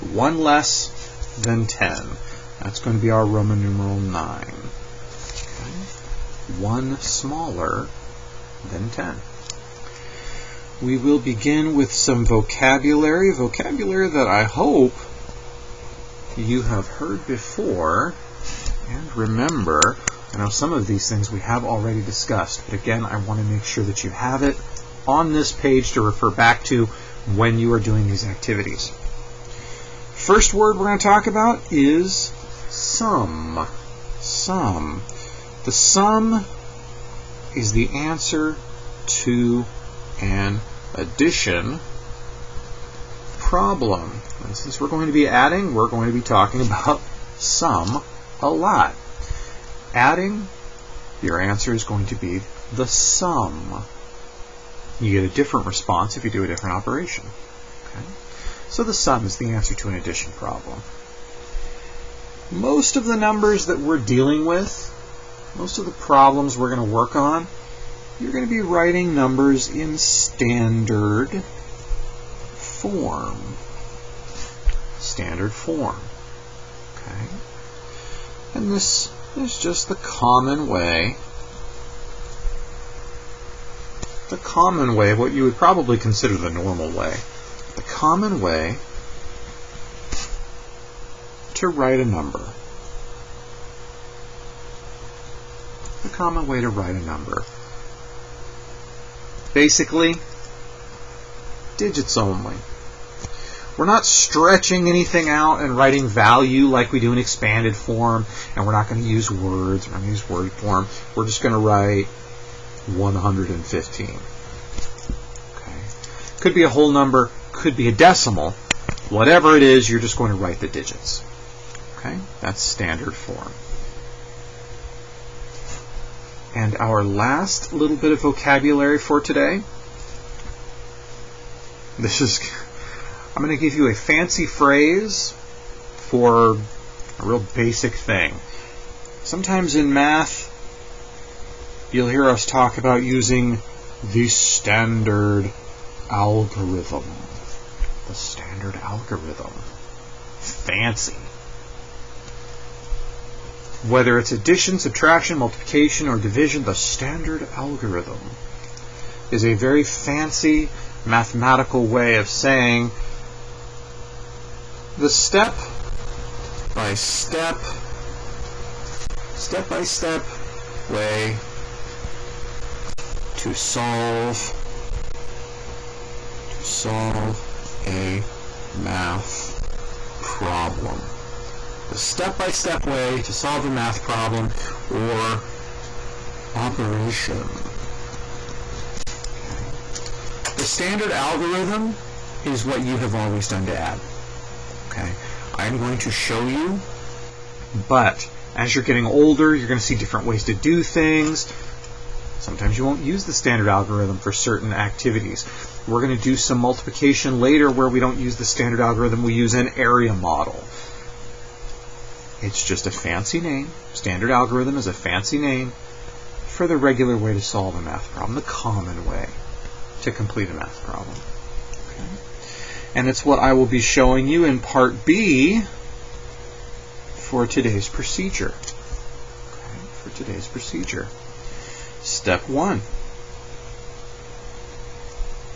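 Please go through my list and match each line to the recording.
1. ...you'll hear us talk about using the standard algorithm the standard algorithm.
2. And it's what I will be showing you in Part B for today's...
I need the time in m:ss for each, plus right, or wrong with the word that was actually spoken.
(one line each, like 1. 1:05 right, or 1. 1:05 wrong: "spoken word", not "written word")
1. 2:21 right
2. 3:42 right.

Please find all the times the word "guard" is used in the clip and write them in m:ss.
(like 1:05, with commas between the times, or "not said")
not said.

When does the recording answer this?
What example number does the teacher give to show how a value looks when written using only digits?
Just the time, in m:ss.
1:52.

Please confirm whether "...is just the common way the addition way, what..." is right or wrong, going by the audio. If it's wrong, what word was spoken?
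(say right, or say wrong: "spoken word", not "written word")
wrong: "common", not "addition".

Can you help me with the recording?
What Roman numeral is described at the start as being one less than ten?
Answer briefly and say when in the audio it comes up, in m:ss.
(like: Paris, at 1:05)
9, at 0:03.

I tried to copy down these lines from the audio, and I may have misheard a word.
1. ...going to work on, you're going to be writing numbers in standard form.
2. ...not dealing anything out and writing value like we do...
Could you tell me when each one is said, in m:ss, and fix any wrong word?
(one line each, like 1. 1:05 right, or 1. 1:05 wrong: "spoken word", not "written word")
1. 1:06 right
2. 1:43 wrong: "stretching", not "dealing".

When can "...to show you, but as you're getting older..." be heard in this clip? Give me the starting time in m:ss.
3:15.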